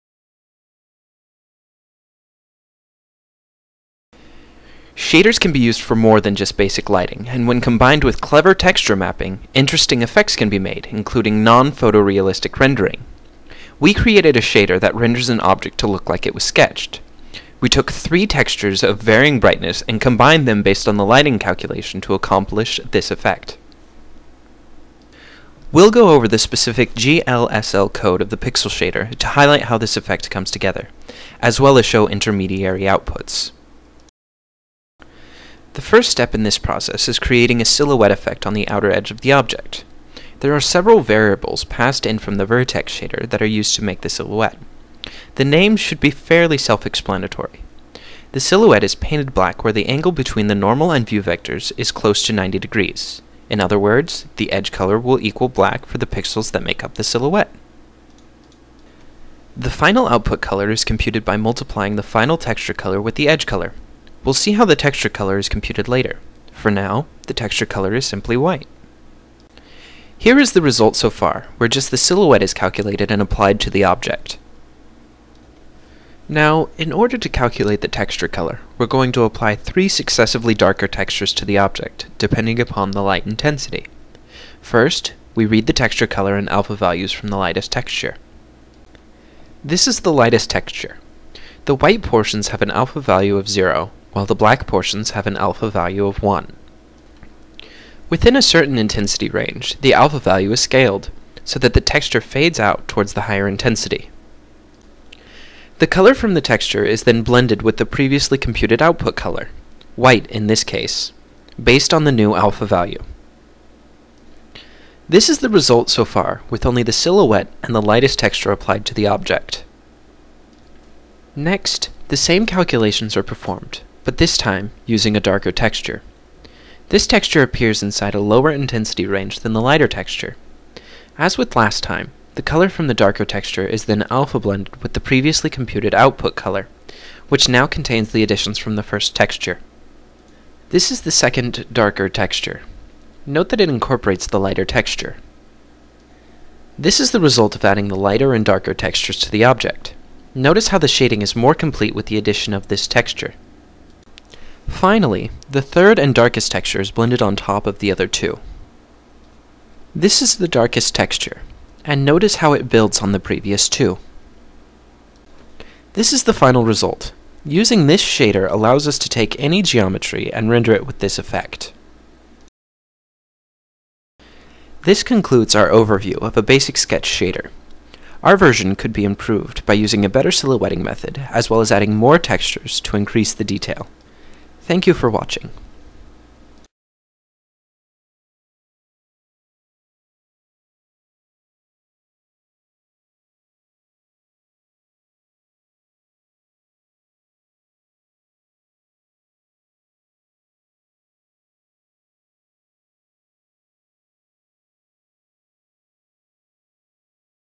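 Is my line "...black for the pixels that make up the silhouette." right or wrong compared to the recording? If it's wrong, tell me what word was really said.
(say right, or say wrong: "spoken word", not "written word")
right.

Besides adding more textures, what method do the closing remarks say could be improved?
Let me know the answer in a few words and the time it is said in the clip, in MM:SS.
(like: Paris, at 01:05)
silhouetting method, at 03:00.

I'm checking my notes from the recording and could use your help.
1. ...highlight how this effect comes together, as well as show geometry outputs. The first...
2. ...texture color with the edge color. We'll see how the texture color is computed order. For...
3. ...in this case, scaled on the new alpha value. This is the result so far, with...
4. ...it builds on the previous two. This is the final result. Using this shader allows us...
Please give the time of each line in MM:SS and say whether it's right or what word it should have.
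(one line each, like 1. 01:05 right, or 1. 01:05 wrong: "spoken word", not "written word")
1. 00:29 wrong: "intermediary", not "geometry"
2. 01:02 wrong: "later", not "order"
3. 01:50 wrong: "based", not "scaled"
4. 02:42 right.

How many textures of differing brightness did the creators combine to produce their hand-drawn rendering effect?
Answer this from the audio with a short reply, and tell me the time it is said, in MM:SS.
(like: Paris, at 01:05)
3, at 00:17.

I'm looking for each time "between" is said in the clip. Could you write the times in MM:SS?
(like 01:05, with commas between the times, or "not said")
00:50.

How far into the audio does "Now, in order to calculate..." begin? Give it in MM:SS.
01:16.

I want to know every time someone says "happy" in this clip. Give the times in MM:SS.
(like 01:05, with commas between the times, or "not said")
not said.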